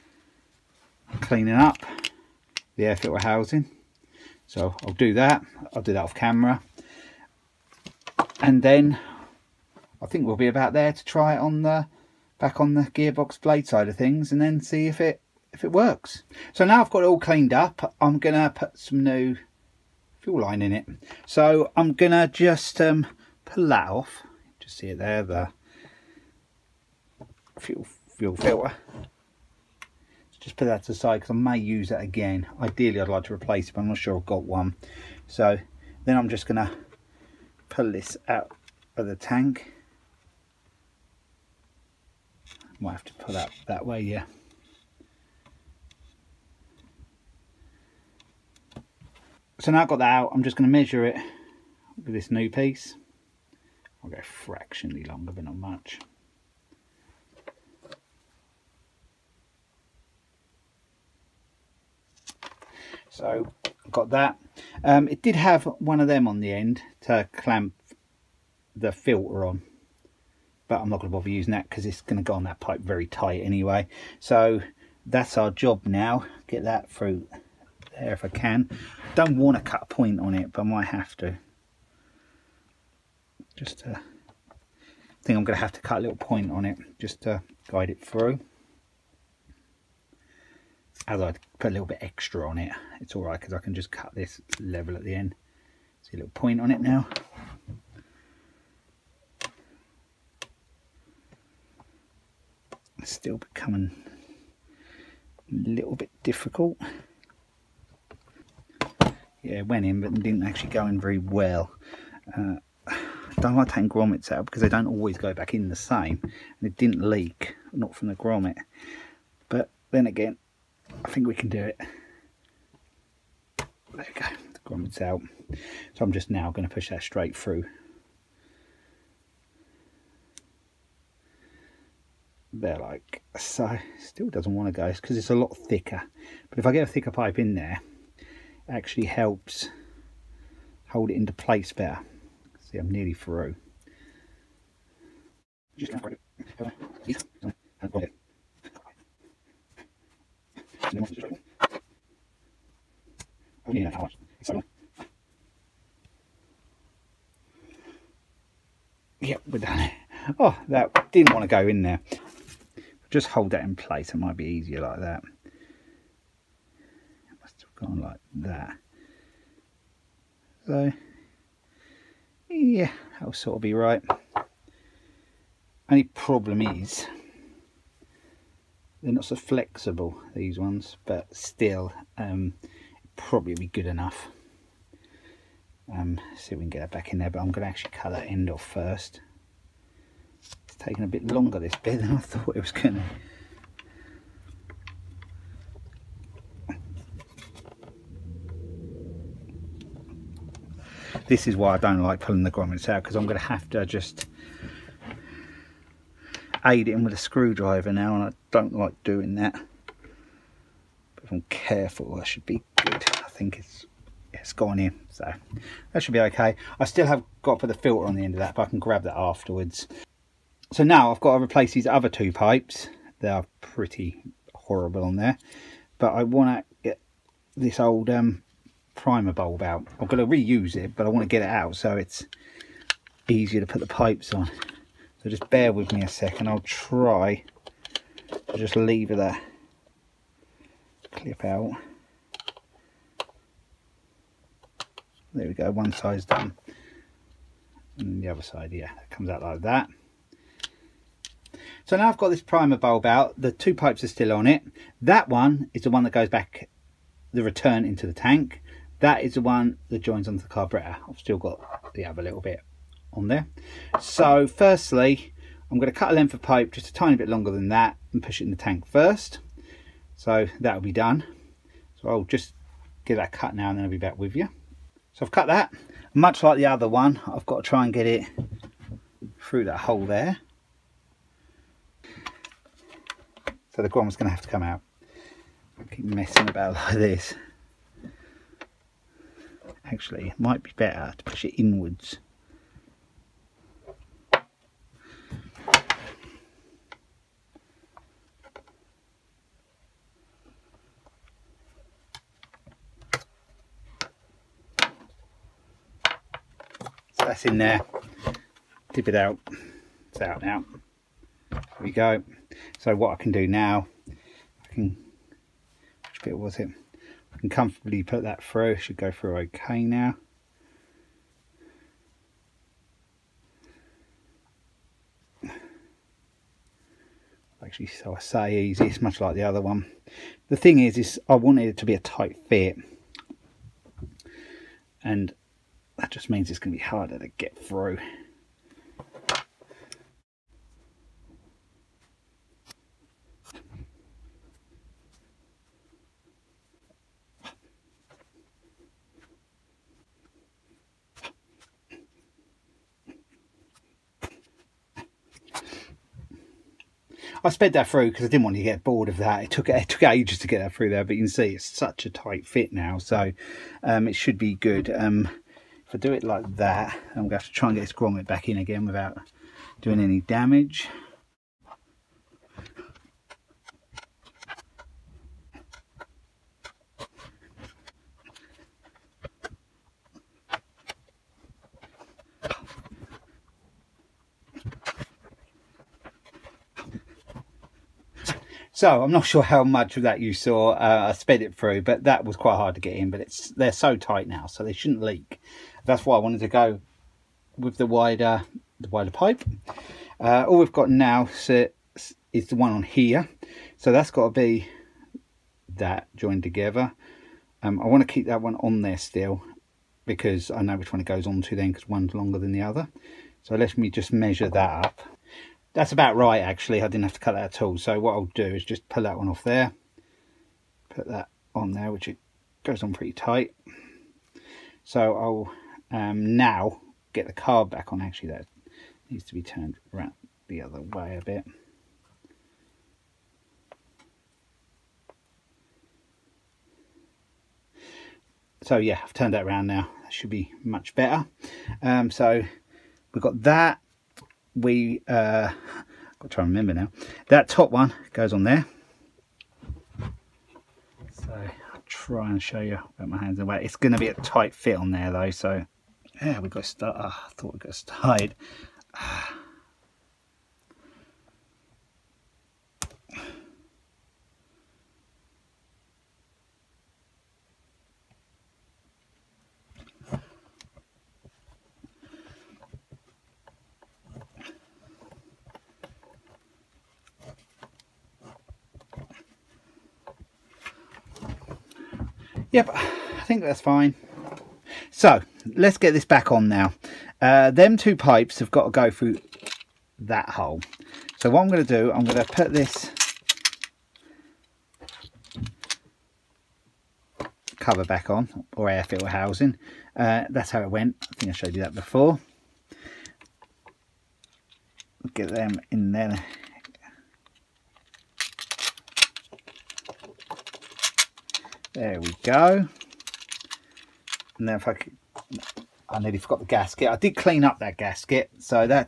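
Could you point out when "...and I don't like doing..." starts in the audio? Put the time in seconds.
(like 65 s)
208 s.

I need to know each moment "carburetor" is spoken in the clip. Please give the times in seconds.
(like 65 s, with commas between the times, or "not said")
260 s.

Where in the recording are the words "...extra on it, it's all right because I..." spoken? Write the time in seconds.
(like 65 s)
92 s.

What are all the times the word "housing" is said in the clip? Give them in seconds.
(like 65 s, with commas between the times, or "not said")
3 s, 499 s.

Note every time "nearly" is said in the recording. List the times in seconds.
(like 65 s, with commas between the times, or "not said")
142 s, 515 s.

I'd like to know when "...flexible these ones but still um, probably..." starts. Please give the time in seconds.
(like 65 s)
179 s.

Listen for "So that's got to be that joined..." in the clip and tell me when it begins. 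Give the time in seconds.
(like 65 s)
403 s.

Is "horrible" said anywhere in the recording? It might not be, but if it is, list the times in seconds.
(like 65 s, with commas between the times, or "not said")
224 s.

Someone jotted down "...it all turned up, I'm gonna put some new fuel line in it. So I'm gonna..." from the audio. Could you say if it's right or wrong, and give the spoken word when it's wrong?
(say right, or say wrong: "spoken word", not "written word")
wrong: "cleaned", not "turned".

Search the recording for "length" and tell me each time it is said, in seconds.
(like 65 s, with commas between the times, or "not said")
266 s.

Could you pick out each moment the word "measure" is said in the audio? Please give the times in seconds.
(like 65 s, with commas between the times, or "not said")
50 s, 414 s.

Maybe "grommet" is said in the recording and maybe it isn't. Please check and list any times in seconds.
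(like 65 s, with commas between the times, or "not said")
113 s, 118 s, 124 s, 202 s, 283 s, 367 s.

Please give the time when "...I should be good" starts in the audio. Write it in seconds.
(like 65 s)
212 s.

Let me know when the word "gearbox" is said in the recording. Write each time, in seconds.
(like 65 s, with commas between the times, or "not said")
12 s.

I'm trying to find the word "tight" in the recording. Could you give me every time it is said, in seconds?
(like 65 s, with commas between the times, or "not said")
73 s, 331 s, 362 s, 393 s, 423 s, 454 s.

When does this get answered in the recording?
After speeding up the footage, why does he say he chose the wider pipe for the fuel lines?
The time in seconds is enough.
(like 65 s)
394 s.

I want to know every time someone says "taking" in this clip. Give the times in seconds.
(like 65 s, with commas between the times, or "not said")
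113 s.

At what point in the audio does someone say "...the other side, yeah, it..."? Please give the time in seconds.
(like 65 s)
248 s.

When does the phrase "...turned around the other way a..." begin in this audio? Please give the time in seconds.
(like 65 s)
429 s.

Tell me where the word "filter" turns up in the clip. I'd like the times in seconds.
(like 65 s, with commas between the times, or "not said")
2 s, 28 s, 68 s, 217 s, 498 s.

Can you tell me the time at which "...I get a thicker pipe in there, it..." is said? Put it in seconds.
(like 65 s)
136 s.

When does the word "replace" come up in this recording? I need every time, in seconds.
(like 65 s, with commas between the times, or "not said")
33 s, 221 s.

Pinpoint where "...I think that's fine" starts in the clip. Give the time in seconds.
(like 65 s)
482 s.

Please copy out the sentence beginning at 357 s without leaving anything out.
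I sped that through because I didn't want to get bored of that.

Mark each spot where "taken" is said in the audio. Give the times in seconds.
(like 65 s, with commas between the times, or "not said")
190 s.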